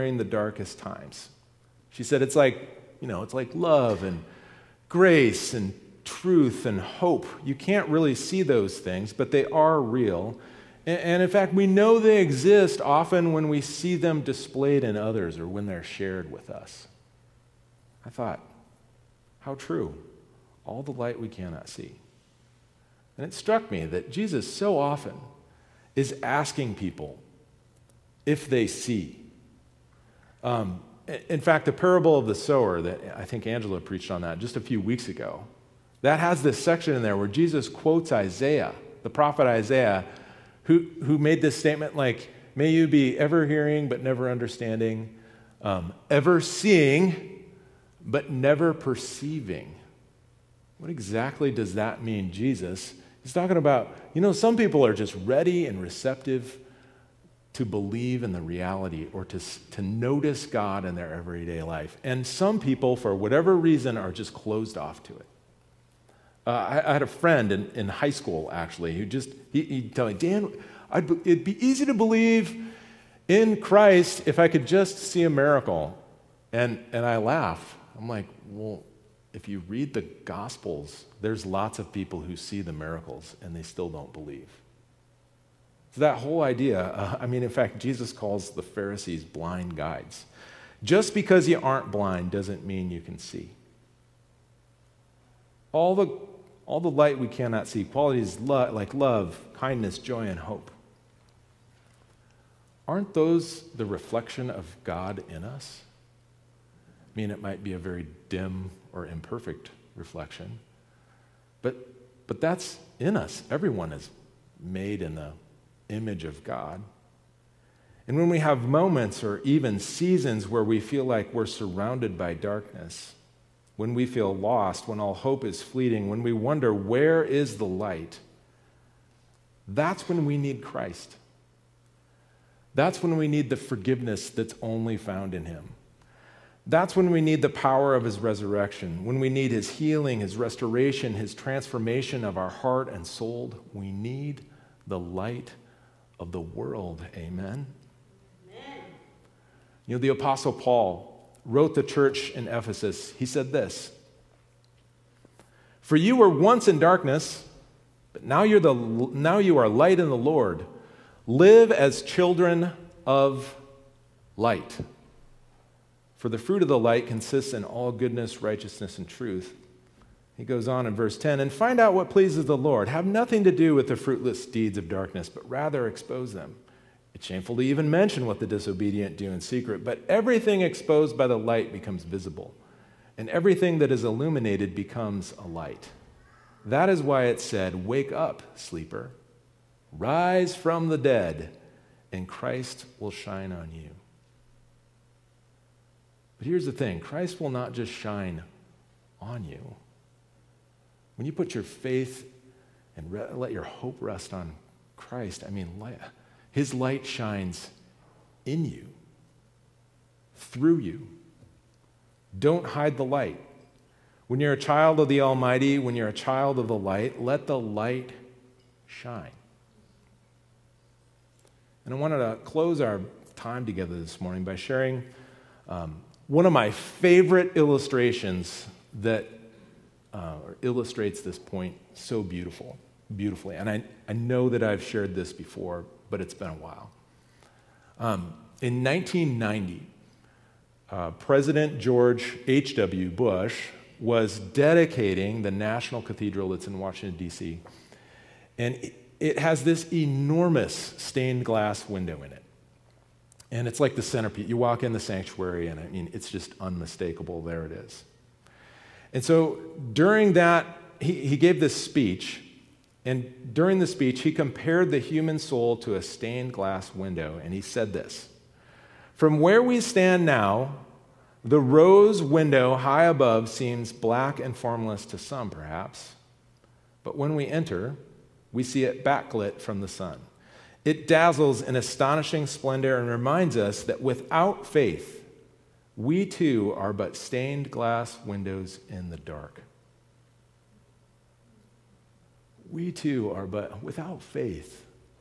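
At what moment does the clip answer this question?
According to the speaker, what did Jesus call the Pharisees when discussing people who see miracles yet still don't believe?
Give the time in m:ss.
1:29.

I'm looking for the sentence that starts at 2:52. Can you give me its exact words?
Have nothing to do with the fruitless deeds of darkness, but rather expose them.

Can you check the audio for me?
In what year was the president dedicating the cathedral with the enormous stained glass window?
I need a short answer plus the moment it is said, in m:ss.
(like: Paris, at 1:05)
1990, at 3:58.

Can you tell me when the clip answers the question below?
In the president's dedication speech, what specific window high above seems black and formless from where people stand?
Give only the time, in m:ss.
4:31.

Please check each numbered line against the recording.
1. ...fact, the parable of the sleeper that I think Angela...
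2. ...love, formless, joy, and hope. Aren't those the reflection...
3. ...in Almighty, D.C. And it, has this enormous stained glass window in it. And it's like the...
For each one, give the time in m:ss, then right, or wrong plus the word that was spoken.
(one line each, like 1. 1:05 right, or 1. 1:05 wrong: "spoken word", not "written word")
1. 0:31 wrong: "sower", not "sleeper"
2. 1:38 wrong: "kindness", not "formless"
3. 4:06 wrong: "Washington", not "Almighty".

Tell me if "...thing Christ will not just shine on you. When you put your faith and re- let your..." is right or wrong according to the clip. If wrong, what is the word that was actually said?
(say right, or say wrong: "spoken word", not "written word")
right.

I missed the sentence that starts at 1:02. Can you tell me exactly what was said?
And some people, for whatever reason, are just closed off to it.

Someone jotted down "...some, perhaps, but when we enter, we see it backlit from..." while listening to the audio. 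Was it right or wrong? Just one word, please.
right.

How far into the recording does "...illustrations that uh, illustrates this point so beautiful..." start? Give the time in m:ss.
3:47.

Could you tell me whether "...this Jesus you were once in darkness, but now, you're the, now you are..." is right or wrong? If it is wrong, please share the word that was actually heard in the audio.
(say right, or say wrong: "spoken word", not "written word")
wrong: "For", not "Jesus".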